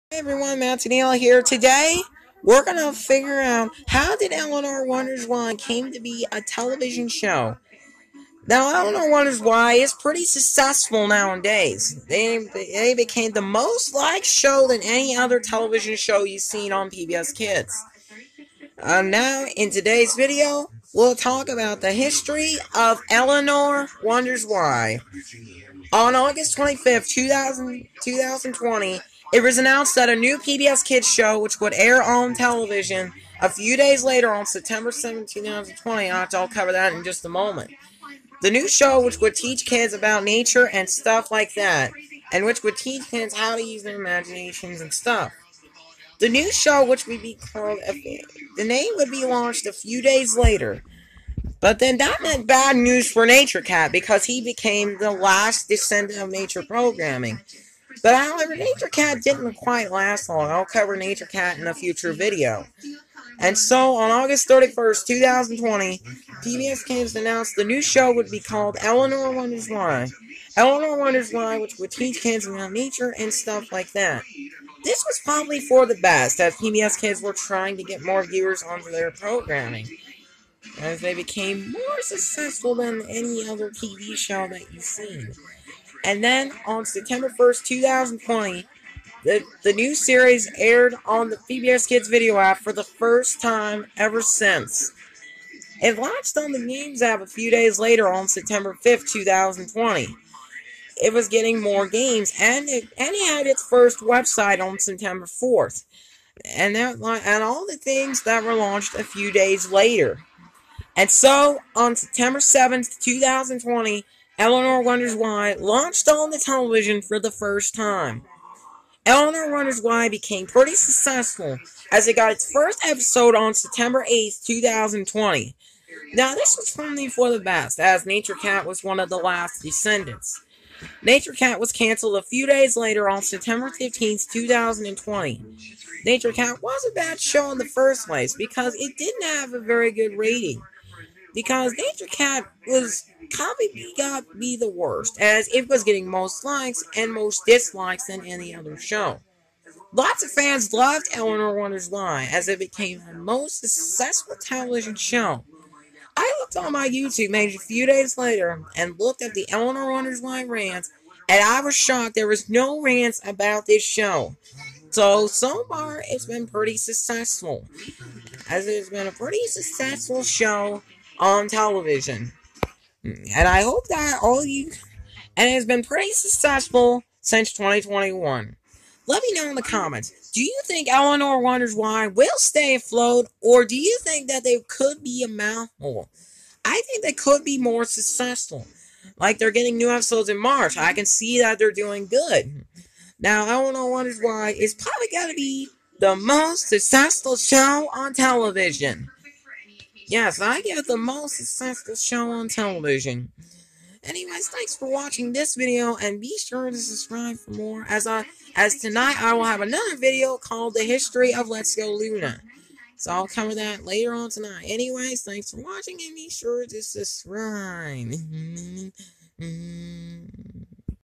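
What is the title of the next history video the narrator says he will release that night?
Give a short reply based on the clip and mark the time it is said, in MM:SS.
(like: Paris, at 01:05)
Let's Go Luna, at 03:31.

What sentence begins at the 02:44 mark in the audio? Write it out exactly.
So, so far, it's been pretty successful.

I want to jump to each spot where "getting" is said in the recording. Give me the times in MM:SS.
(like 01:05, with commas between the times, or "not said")
01:41, 02:25, 03:09.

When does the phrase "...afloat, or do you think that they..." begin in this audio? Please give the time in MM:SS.
03:02.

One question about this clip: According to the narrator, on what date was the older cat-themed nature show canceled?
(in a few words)
September 15, 2020.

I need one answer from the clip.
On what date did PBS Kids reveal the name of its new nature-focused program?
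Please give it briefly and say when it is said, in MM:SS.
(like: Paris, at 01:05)
August 31st, 2020, at 01:04.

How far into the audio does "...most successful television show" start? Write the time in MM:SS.
02:33.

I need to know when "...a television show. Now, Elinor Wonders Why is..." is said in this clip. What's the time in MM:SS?
00:06.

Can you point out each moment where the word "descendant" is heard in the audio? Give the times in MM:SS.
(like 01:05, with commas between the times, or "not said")
00:55, 02:09.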